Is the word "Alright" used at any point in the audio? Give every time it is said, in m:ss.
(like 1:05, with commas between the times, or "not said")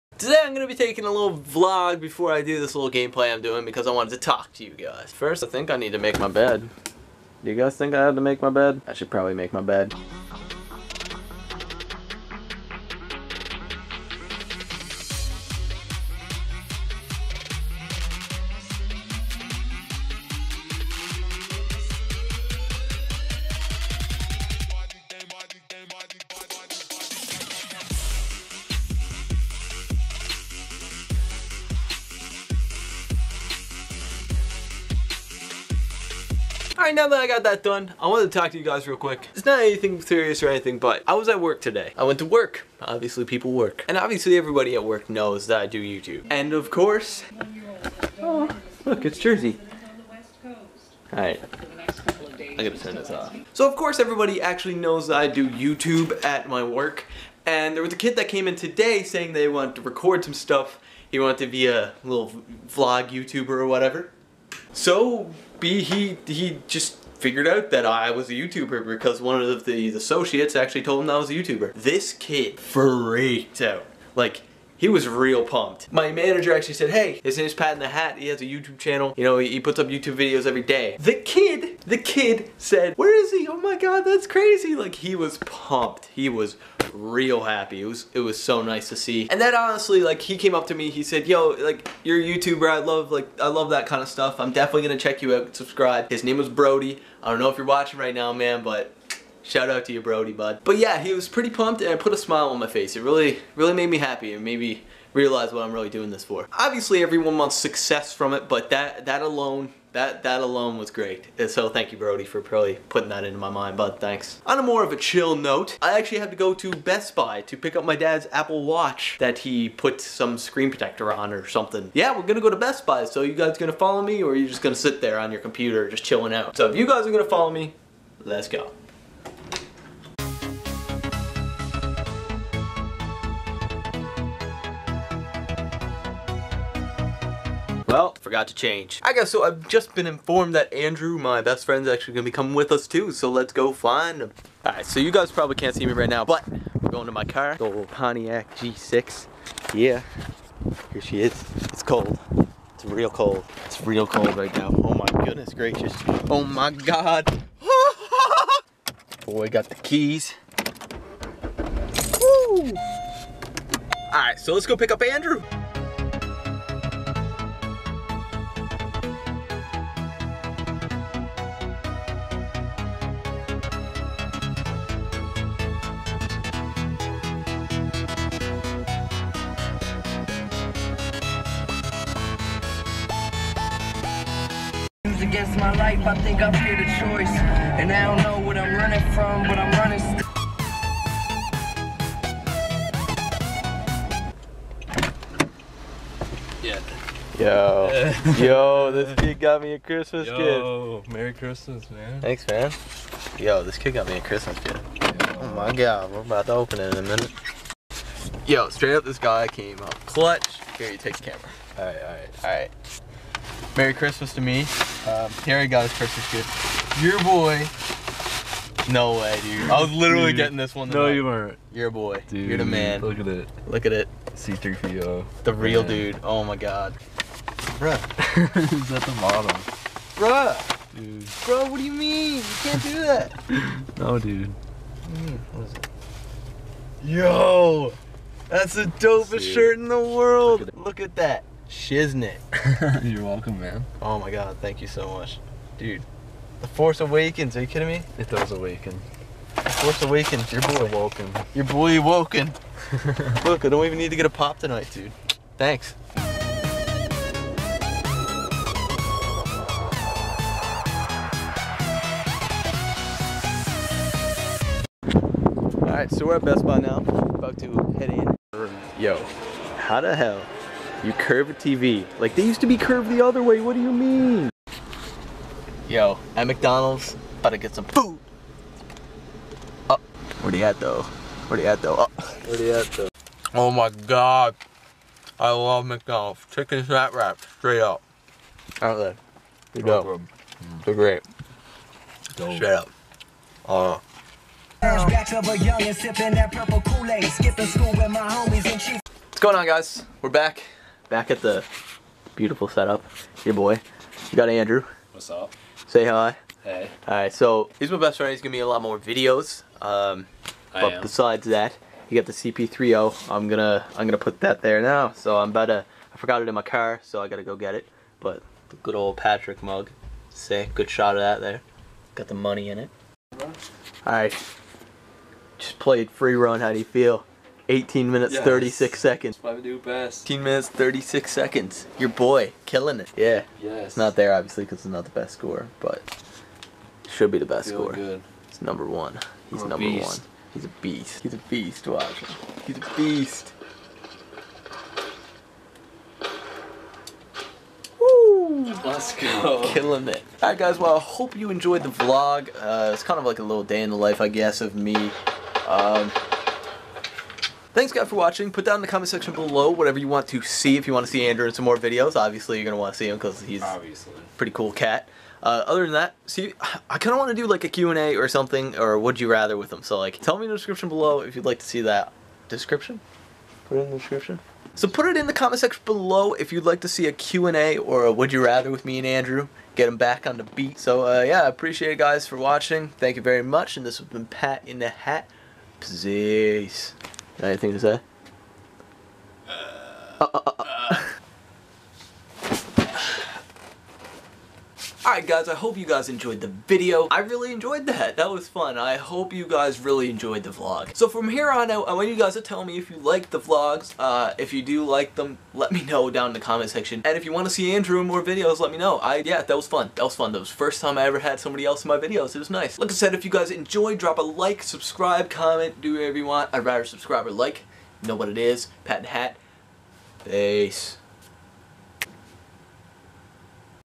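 0:36, 0:51, 2:24, 4:25, 5:07, 5:24, 5:50.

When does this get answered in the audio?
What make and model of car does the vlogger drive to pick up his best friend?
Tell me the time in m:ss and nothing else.
2:27.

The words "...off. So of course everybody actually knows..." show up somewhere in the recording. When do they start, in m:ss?
0:53.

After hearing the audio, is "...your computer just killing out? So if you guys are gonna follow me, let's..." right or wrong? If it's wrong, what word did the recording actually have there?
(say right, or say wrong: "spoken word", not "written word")
wrong: "chilling", not "killing".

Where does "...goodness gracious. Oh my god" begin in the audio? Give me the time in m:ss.
2:35.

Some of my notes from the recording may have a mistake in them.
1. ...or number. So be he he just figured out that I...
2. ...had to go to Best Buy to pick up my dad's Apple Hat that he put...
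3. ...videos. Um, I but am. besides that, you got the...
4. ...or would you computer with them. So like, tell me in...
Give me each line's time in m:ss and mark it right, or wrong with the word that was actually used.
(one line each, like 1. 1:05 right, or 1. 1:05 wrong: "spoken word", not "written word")
1. 1:03 wrong: "whatever", not "number"
2. 1:56 wrong: "Watch", not "Hat"
3. 5:08 right
4. 6:08 wrong: "rather", not "computer".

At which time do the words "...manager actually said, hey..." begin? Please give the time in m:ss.
1:16.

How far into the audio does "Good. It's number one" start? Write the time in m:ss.
5:37.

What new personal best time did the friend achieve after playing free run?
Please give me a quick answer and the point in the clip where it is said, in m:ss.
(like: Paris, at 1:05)
18 minutes 36 seconds, at 5:30.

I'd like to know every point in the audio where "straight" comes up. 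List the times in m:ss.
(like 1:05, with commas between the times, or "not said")
3:28, 4:47, 4:52.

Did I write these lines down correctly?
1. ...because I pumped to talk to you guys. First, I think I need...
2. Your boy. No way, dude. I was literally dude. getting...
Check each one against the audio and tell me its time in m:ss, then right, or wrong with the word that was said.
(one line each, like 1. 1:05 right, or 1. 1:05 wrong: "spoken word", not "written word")
1. 0:03 wrong: "wanted", not "pumped"
2. 3:37 right.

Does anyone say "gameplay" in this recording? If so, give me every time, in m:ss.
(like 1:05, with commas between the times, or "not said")
0:02.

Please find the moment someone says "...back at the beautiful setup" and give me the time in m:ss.
5:01.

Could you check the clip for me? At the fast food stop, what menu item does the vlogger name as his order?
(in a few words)
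Chicken snack wrap.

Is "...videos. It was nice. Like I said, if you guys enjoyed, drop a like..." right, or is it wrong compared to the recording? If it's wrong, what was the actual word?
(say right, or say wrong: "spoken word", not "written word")
right.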